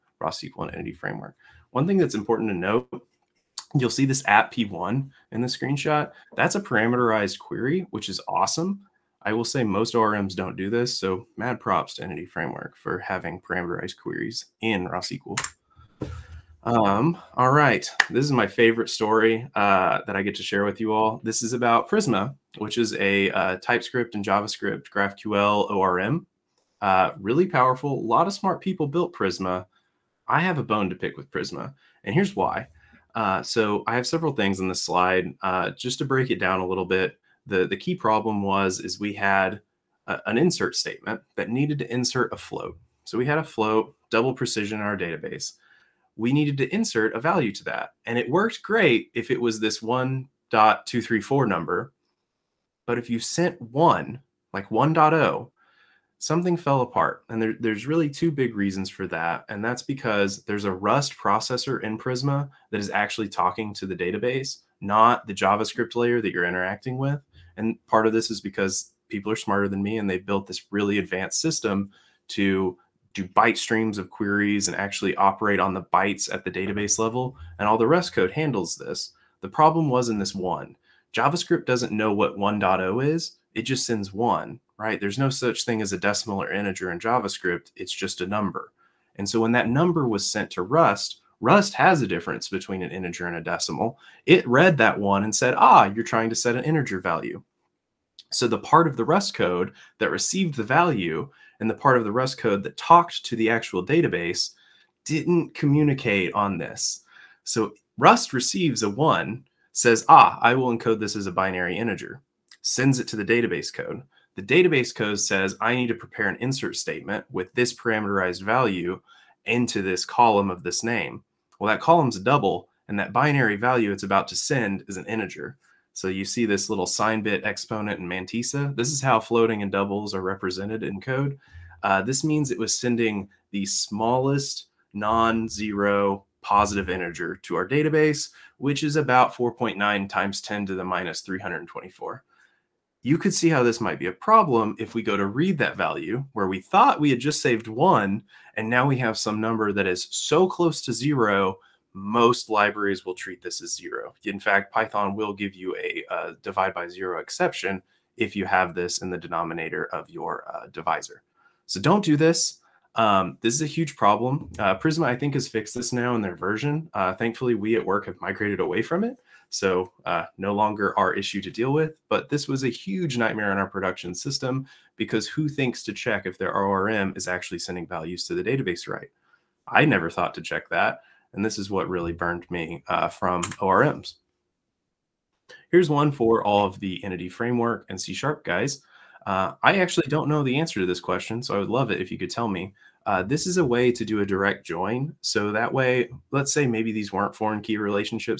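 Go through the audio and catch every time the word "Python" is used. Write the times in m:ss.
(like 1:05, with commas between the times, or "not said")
2:34.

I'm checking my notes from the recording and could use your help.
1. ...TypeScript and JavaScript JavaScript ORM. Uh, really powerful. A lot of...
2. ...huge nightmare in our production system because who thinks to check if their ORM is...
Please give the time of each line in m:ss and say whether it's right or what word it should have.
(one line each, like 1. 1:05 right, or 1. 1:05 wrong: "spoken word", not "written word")
1. 0:23 wrong: "GraphQL", not "JavaScript"
2. 2:52 right.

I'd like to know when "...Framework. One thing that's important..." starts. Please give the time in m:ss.
0:00.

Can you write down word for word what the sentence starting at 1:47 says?
So Rust receives a one, says, ah, I will encode this as a binary integer, sends it to the database code.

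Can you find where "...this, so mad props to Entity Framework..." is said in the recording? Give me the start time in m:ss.
0:10.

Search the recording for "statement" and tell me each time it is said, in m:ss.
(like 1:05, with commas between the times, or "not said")
0:40, 1:56.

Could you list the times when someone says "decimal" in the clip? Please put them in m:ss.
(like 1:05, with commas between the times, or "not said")
1:25, 1:33.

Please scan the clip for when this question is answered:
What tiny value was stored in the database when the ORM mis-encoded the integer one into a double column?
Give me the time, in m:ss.
2:19.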